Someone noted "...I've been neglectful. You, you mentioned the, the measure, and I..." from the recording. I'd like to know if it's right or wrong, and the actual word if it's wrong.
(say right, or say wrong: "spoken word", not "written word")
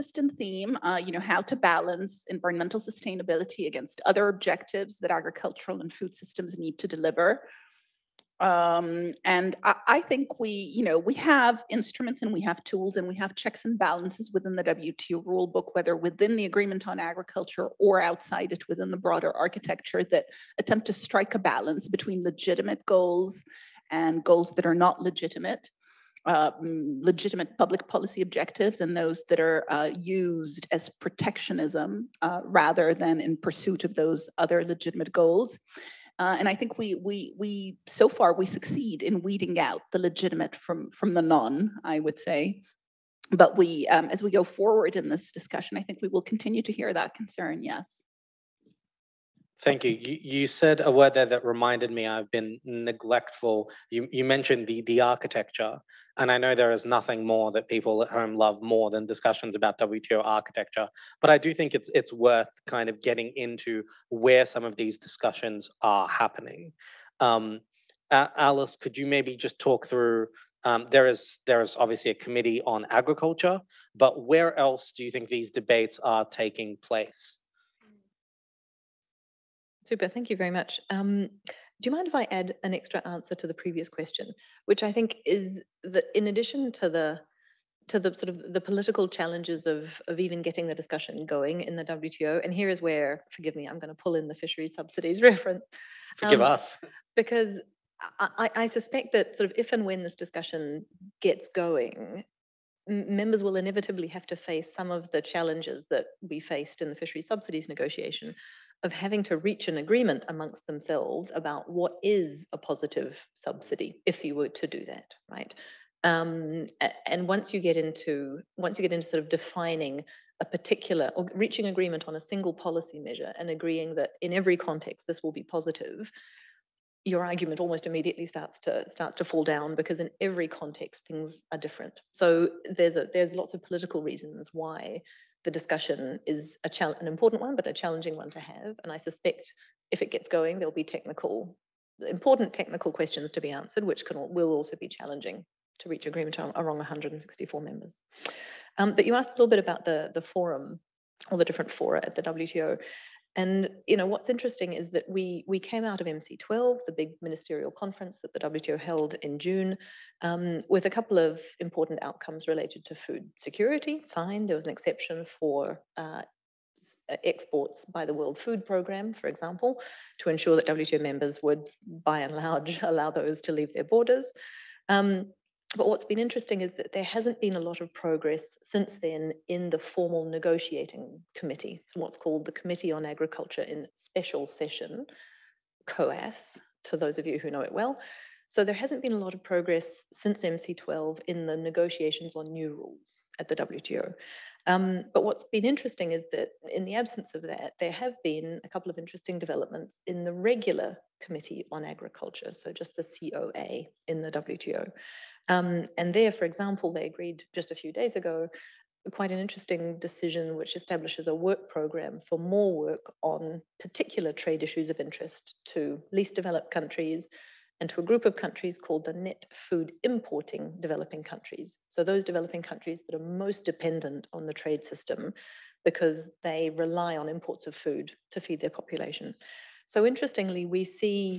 wrong: "architecture", not "measure".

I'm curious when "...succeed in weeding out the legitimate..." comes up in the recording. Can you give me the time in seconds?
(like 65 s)
38 s.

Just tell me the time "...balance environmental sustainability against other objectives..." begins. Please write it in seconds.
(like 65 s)
1 s.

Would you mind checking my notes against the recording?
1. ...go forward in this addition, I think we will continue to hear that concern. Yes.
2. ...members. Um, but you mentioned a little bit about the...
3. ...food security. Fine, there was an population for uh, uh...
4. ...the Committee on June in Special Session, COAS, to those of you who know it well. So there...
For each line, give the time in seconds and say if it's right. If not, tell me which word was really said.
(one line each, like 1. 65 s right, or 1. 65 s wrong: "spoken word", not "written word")
1. 44 s wrong: "discussion", not "addition"
2. 147 s wrong: "asked", not "mentioned"
3. 162 s wrong: "exception", not "population"
4. 182 s wrong: "Agriculture", not "June".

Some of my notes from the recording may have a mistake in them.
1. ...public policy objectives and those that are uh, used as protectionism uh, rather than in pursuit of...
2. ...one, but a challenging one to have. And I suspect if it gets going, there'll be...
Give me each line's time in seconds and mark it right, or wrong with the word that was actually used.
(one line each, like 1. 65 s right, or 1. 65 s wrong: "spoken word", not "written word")
1. 27 s right
2. 137 s right.